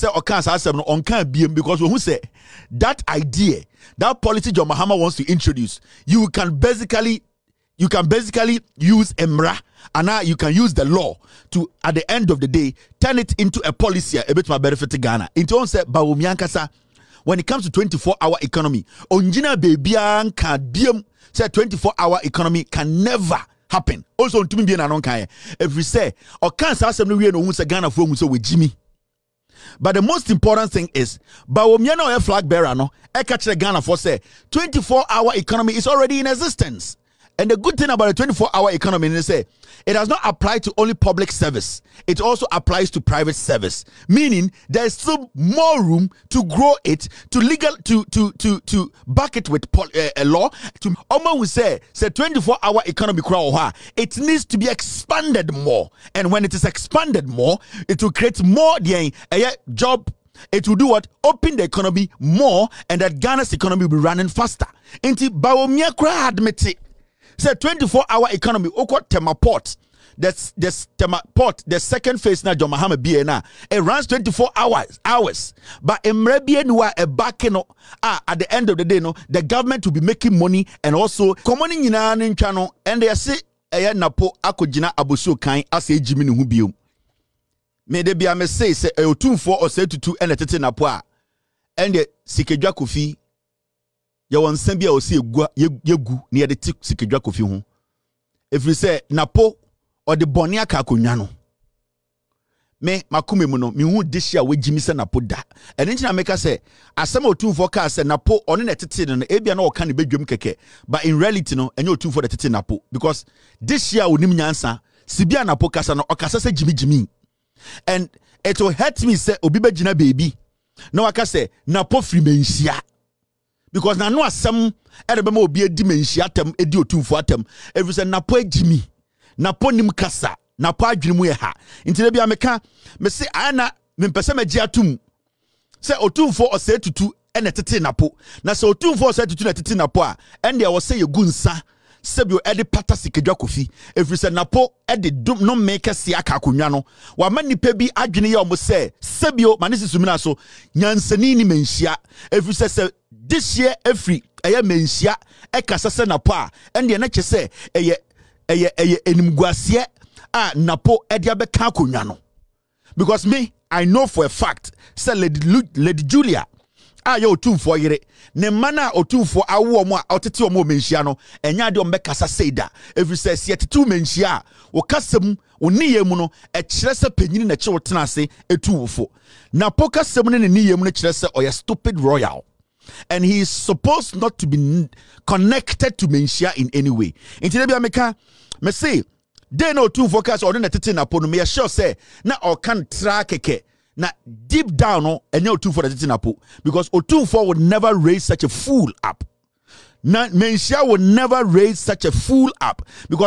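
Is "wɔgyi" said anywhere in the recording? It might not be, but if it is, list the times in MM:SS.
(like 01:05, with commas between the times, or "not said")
00:28, 01:44.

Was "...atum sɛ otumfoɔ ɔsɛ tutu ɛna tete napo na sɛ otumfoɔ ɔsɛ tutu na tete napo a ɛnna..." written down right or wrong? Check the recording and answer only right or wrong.
right.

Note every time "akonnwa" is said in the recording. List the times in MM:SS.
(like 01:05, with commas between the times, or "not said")
01:40, 02:26, 02:41.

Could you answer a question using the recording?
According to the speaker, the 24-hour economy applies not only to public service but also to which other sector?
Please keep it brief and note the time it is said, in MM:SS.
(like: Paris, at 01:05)
private service, at 00:43.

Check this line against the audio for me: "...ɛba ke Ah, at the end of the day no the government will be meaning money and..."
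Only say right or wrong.
wrong.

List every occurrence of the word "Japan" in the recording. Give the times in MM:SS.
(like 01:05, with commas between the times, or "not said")
not said.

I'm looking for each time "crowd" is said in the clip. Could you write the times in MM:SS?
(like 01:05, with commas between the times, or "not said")
00:53.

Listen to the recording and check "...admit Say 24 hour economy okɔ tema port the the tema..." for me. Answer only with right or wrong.
right.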